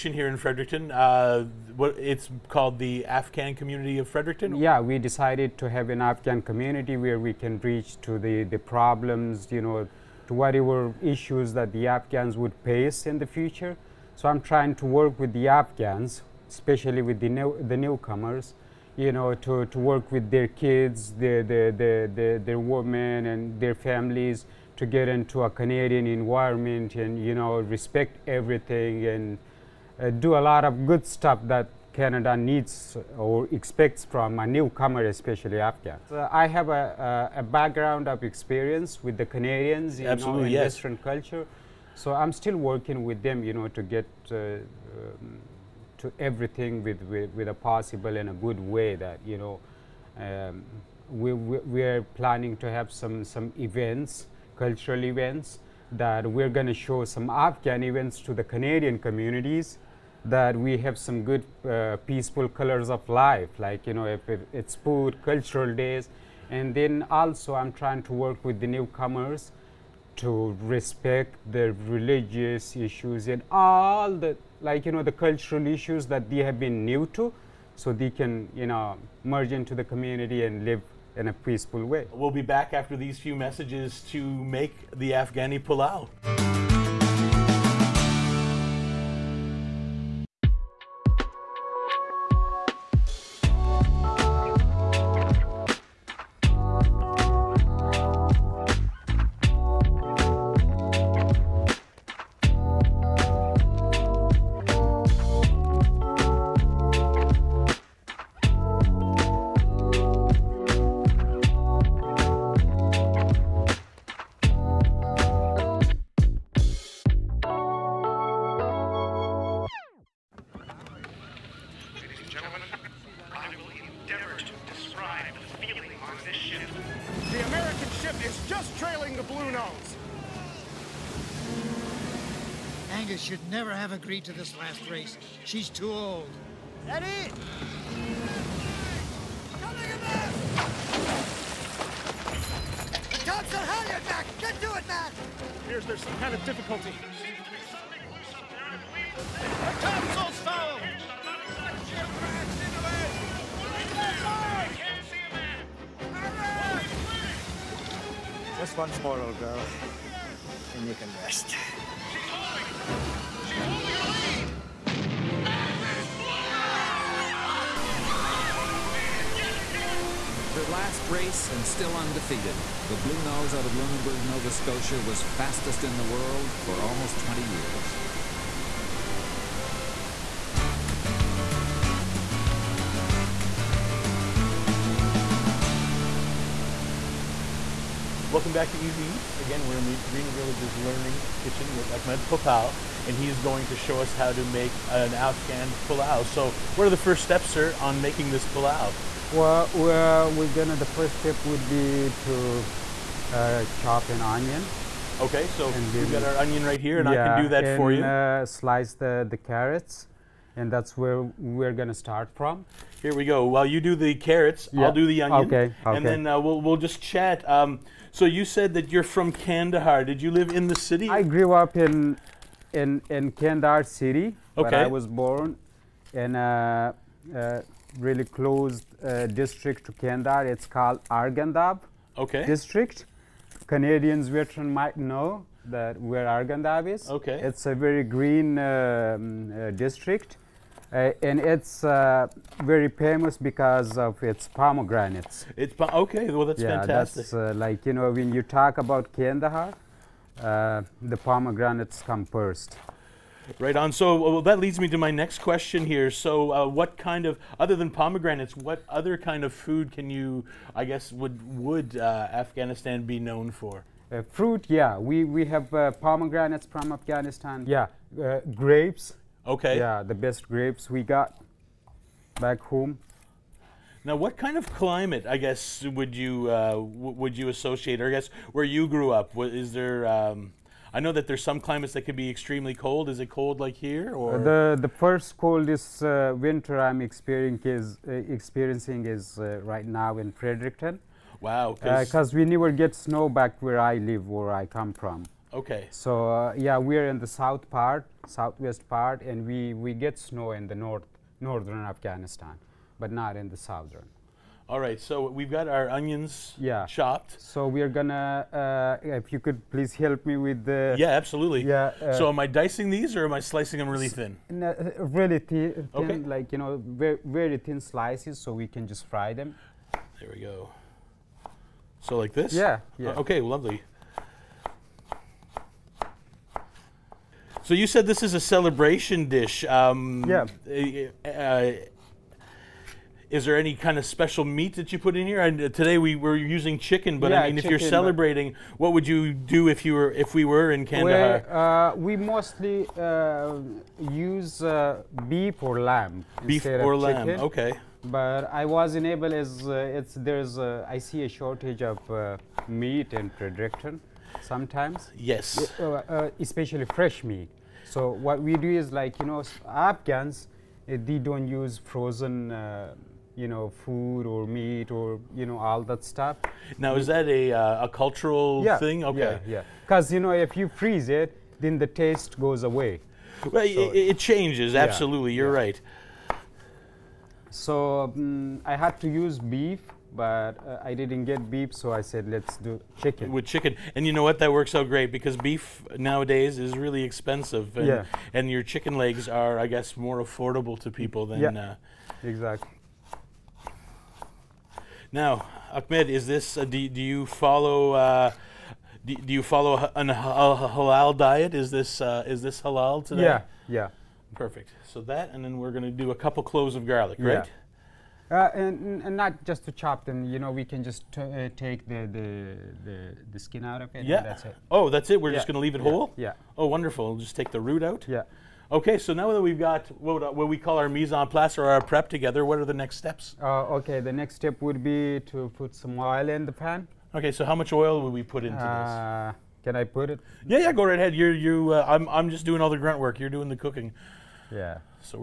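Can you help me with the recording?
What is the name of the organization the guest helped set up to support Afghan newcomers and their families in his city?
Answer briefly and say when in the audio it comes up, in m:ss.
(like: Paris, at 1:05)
Afghan Community of Fredericton, at 0:03.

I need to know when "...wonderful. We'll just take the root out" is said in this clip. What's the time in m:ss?
6:56.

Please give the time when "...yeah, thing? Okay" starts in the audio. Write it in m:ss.
6:08.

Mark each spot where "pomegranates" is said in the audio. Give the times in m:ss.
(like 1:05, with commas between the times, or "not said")
4:04, 4:11, 4:17, 4:25.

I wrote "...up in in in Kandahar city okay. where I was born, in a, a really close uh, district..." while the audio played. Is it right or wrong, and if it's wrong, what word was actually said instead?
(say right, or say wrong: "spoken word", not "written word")
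right.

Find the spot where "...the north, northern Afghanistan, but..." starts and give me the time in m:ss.
5:00.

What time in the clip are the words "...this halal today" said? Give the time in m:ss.
6:42.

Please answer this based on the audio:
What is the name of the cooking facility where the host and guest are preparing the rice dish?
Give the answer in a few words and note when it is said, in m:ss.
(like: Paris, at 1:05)
Greener Village's Learning Kitchen, at 3:10.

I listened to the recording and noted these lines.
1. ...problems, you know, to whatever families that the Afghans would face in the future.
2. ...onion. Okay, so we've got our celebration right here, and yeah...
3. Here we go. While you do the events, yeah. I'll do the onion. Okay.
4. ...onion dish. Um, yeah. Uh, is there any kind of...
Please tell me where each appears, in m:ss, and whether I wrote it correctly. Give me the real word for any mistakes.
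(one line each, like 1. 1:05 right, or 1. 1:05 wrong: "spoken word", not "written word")
1. 0:08 wrong: "issues", not "families"
2. 3:24 wrong: "onion", not "celebration"
3. 3:33 wrong: "carrots", not "events"
4. 5:28 wrong: "celebration", not "onion".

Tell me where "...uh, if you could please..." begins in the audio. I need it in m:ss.
5:08.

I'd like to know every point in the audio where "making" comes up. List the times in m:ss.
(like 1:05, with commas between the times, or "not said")
3:18.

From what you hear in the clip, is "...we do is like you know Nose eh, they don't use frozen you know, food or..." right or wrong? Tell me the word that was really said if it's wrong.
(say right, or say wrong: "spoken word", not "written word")
wrong: "Afghans", not "Nose".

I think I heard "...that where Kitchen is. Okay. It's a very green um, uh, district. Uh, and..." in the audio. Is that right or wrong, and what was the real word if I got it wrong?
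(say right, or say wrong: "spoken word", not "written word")
wrong: "Arghandab", not "Kitchen".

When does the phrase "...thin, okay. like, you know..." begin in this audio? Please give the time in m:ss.
5:15.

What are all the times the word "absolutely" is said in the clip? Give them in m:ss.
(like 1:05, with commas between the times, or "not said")
0:40, 5:11, 6:14.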